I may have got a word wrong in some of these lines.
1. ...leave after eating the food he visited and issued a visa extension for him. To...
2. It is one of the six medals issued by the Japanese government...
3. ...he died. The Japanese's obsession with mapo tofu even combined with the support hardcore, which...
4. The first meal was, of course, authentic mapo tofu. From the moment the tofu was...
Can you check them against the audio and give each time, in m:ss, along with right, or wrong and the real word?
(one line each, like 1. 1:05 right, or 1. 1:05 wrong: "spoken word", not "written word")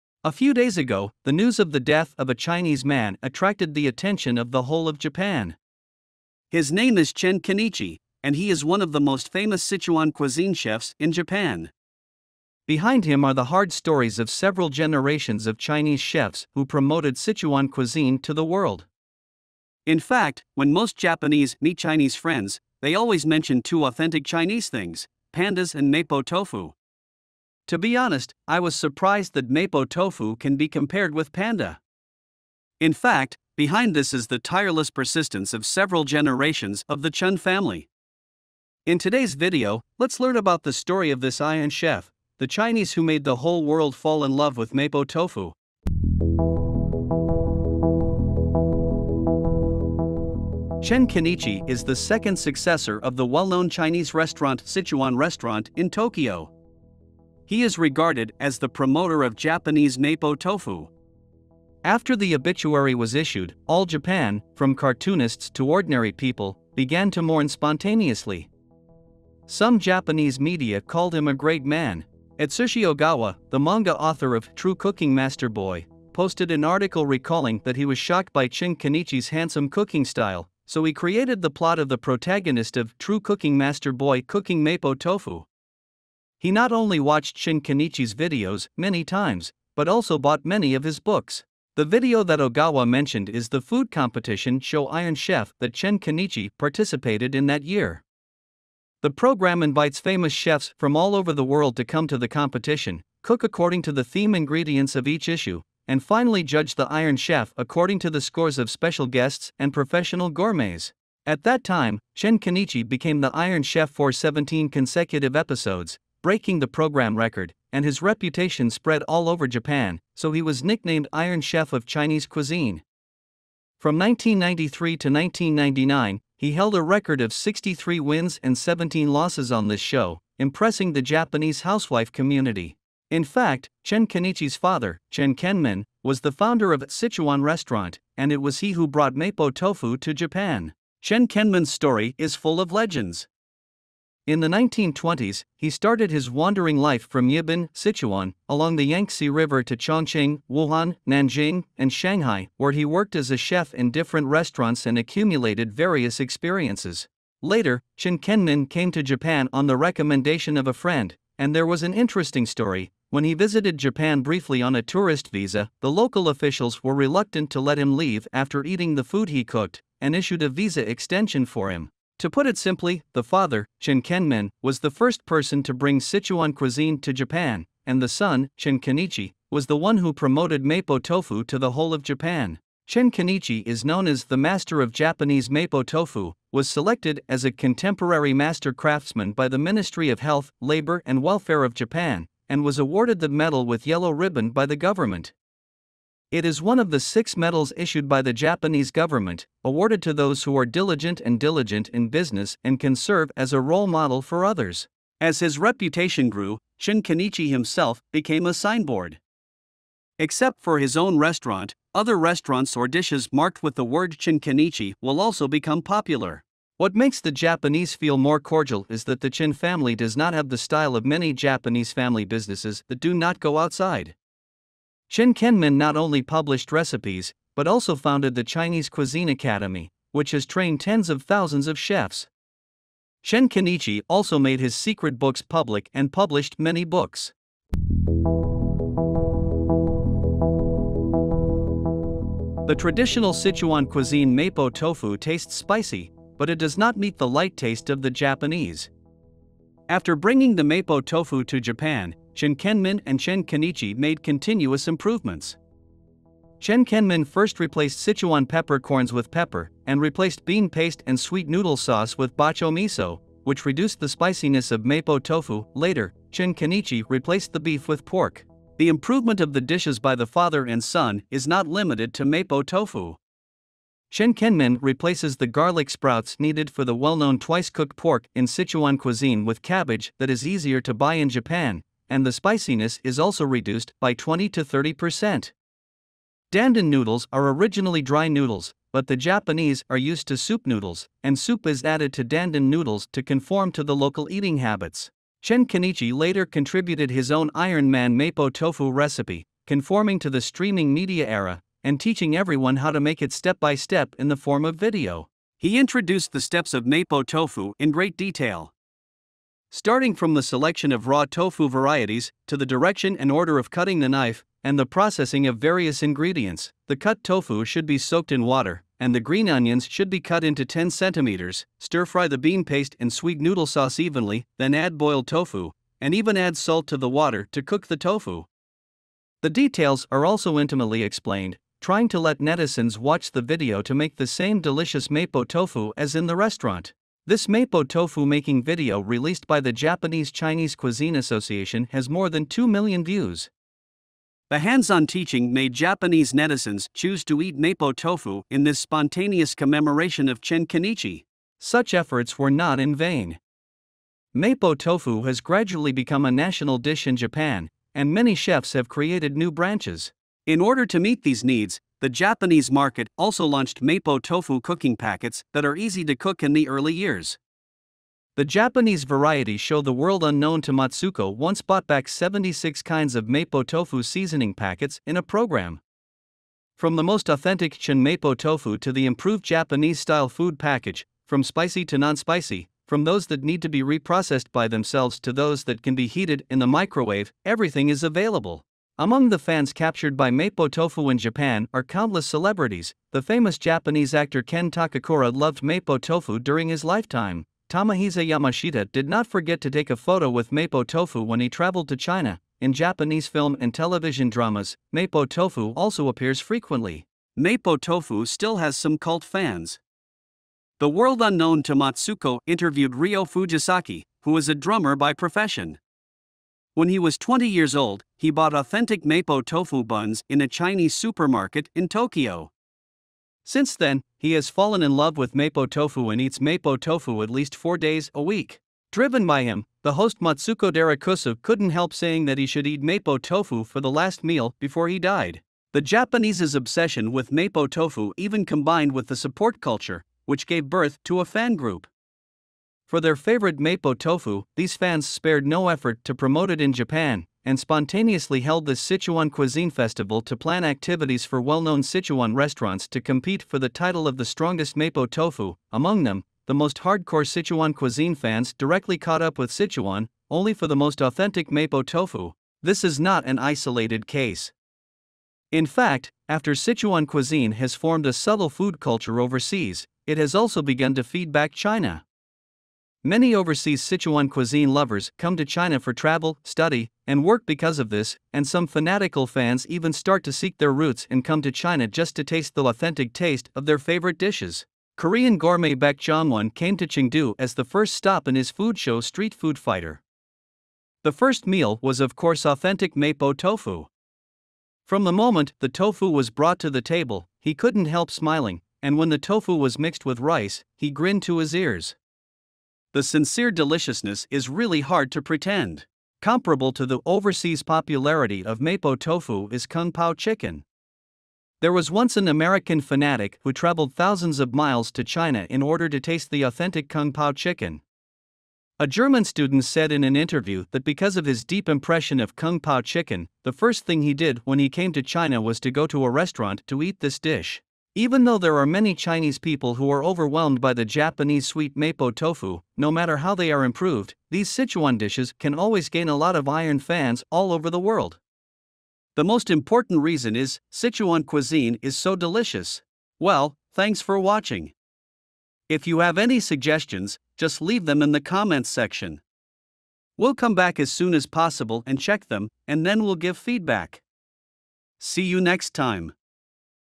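1. 2:47 wrong: "cooked", not "visited"
2. 3:16 right
3. 7:14 wrong: "culture", not "hardcore"
4. 8:11 right.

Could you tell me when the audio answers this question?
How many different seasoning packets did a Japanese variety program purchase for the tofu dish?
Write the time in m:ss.
6:12.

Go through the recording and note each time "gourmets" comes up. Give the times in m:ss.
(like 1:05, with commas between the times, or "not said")
1:50, 8:05.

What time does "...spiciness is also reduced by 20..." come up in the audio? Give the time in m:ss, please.
4:42.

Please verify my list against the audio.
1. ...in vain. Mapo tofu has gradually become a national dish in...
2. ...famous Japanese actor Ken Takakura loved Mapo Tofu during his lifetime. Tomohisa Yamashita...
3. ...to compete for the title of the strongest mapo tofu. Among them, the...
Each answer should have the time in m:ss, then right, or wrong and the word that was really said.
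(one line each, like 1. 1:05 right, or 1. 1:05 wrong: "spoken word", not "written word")
1. 5:52 right
2. 6:33 right
3. 7:32 right.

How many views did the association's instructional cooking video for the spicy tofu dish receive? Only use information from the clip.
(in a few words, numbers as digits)
more than 2 million.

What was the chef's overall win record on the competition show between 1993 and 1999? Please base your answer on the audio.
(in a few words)
63 wins.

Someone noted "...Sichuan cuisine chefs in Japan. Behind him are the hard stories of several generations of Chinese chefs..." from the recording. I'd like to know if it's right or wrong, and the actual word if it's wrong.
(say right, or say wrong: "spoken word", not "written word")
right.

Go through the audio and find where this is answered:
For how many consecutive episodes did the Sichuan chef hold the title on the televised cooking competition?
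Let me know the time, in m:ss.
1:54.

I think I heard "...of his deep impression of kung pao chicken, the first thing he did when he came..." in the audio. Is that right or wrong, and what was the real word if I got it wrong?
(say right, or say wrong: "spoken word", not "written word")
right.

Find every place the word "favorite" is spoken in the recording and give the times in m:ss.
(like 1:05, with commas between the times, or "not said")
7:23, 8:03.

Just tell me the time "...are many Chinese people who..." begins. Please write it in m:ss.
8:48.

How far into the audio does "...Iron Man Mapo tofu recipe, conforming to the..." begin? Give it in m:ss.
4:57.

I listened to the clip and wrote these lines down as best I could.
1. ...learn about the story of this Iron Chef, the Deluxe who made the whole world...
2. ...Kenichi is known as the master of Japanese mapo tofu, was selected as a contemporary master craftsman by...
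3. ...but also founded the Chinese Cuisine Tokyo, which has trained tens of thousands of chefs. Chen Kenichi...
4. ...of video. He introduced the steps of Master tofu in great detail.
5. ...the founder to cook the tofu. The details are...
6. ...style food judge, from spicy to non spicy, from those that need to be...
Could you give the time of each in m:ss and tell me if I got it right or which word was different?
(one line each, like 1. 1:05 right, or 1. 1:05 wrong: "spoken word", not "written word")
1. 0:40 wrong: "Chinese", not "Deluxe"
2. 3:03 right
3. 3:47 wrong: "Academy", not "Tokyo"
4. 5:04 wrong: "Mapo", not "Master"
5. 5:26 wrong: "water", not "founder"
6. 6:19 wrong: "package", not "judge".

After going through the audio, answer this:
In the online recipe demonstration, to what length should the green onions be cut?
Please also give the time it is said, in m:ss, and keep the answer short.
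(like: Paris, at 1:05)
10 centimeters, at 5:20.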